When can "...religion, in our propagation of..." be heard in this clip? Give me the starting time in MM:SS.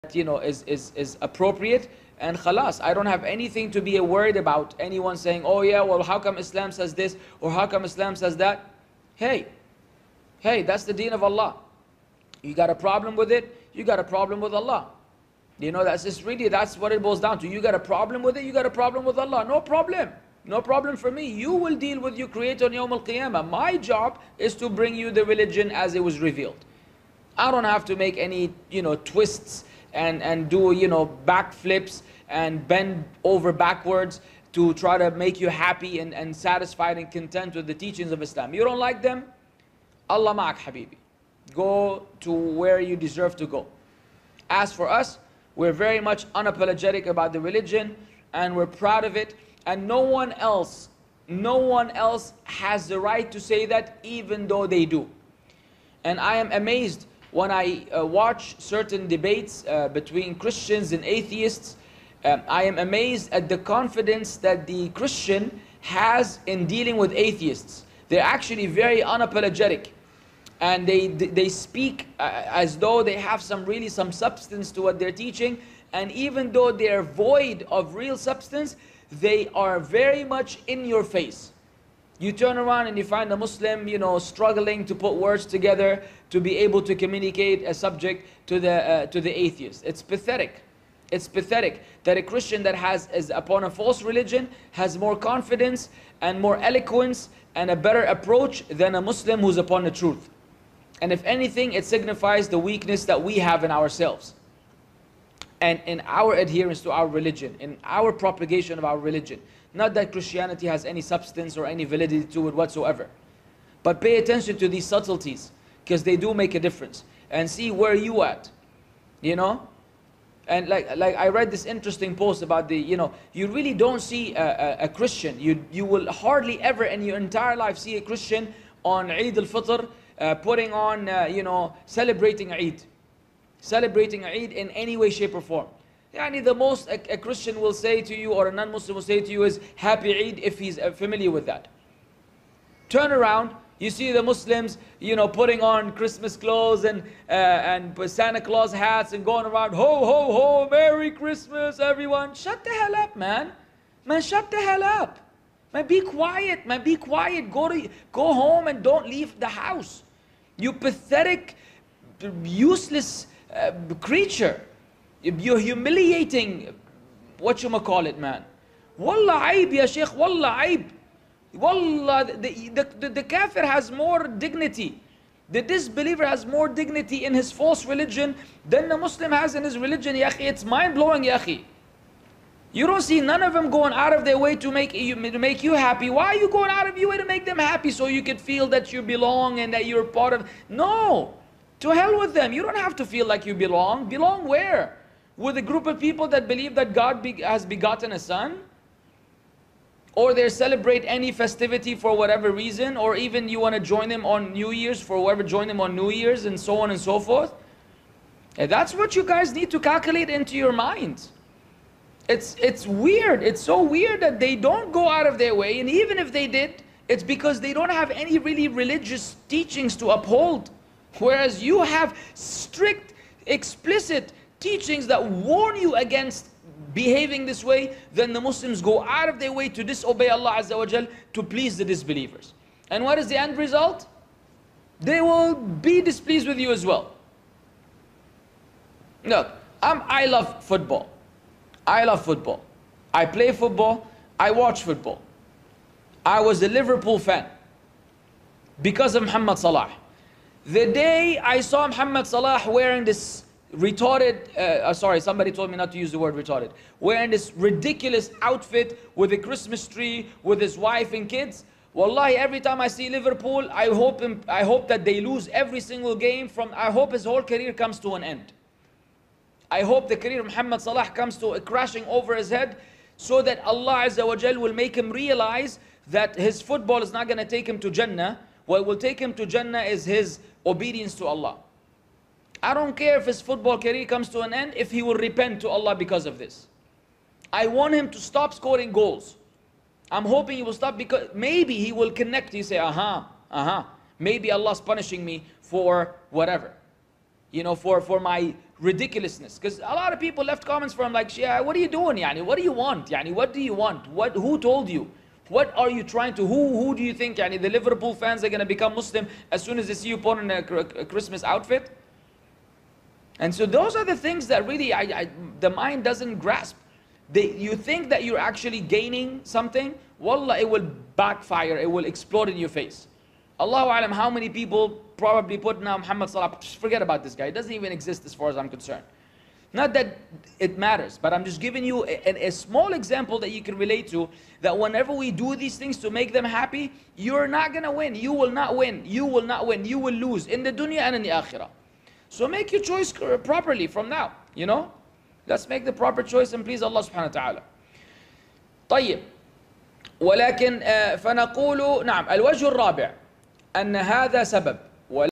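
01:47.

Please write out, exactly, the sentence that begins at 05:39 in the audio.
You will lose in the dunya and in the akhirah.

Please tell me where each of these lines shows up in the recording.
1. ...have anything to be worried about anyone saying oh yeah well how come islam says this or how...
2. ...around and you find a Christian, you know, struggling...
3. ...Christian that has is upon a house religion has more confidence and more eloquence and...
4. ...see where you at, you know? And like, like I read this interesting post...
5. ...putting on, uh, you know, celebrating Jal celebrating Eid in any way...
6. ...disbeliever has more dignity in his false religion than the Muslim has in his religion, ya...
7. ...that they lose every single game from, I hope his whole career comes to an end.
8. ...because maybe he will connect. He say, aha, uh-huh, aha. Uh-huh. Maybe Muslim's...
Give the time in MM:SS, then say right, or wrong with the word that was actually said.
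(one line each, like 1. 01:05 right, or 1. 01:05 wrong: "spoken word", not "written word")
1. 00:03 right
2. 01:22 wrong: "Muslim", not "Christian"
3. 01:32 wrong: "false", not "house"
4. 01:57 right
5. 02:10 wrong: "Eid", not "Jal"
6. 02:55 right
7. 04:24 right
8. 04:50 wrong: "Allah", not "Muslim".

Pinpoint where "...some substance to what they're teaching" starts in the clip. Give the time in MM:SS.
01:13.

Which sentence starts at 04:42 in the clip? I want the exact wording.
I don't care if his football career comes to an end, if he will repent to Allah because of this.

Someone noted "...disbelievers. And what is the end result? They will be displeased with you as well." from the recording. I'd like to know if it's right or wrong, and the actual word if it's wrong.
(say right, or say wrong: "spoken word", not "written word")
right.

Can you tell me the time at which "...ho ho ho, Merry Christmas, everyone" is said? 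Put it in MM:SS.
02:29.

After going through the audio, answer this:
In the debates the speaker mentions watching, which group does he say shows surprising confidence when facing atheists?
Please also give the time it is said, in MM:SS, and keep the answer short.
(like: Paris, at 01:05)
Christians, at 01:00.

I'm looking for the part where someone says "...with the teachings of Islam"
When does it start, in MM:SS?
00:37.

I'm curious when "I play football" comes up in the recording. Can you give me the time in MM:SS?
04:03.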